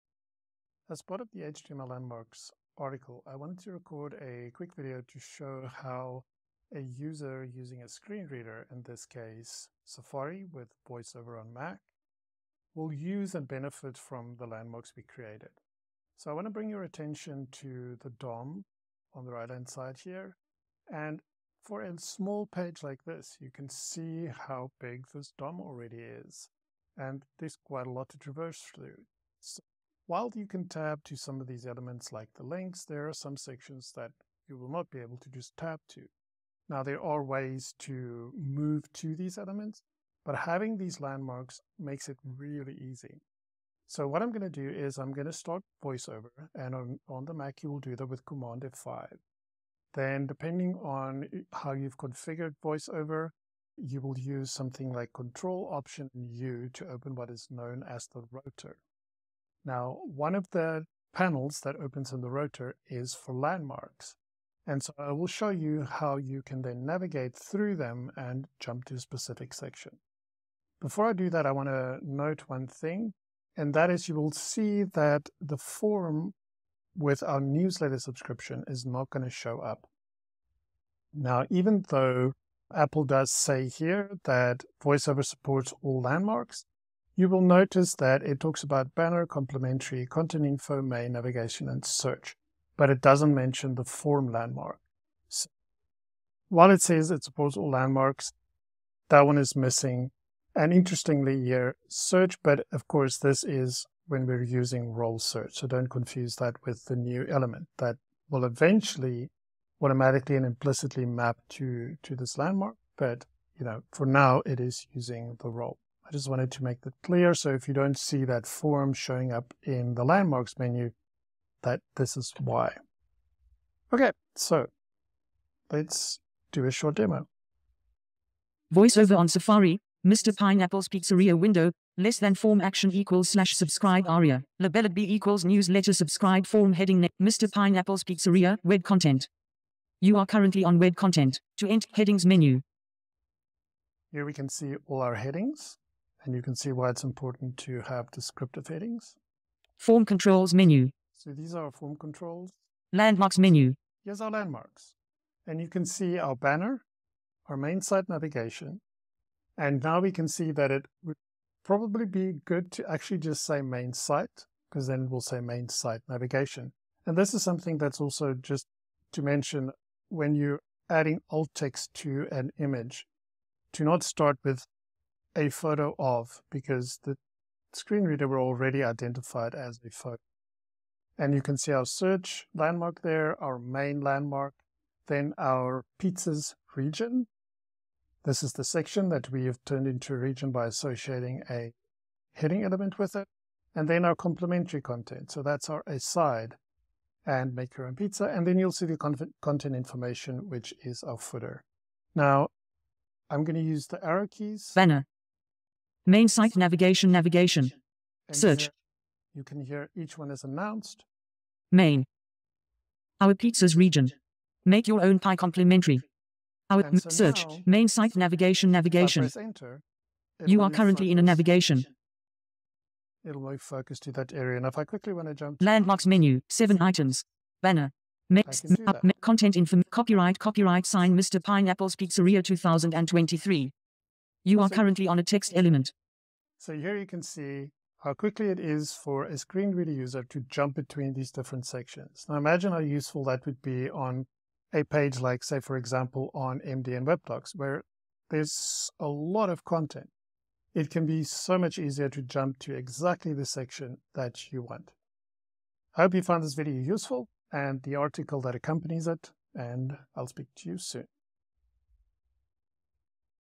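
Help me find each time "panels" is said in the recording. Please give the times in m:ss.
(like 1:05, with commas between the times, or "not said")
1:01.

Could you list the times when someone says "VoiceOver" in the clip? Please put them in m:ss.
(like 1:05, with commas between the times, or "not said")
0:10, 0:45, 0:52, 1:24, 2:08.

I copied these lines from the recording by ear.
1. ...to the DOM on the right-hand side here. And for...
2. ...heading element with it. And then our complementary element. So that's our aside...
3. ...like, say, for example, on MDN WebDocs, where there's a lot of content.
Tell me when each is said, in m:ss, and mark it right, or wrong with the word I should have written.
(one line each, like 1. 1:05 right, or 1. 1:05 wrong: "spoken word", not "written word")
1. 0:17 right
2. 3:12 wrong: "content", not "element"
3. 4:05 right.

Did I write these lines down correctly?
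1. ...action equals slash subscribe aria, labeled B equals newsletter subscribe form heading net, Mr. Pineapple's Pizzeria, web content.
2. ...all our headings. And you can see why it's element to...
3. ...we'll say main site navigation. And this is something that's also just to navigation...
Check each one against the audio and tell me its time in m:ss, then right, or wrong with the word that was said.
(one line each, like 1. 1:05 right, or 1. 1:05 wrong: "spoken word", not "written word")
1. 2:12 right
2. 2:24 wrong: "important", not "element"
3. 2:45 wrong: "mention", not "navigation".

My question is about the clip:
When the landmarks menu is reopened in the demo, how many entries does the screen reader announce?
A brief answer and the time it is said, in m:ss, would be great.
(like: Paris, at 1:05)
7, at 3:46.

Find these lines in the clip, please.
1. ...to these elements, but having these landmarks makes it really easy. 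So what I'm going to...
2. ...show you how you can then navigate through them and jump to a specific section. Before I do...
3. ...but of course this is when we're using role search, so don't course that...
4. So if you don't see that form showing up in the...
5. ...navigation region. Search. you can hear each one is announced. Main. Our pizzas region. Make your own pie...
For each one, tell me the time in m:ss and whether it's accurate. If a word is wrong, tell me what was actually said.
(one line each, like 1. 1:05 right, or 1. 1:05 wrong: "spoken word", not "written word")
1. 0:38 right
2. 1:05 right
3. 1:42 wrong: "confuse", not "course"
4. 1:57 right
5. 3:26 wrong: "navigation", not "region".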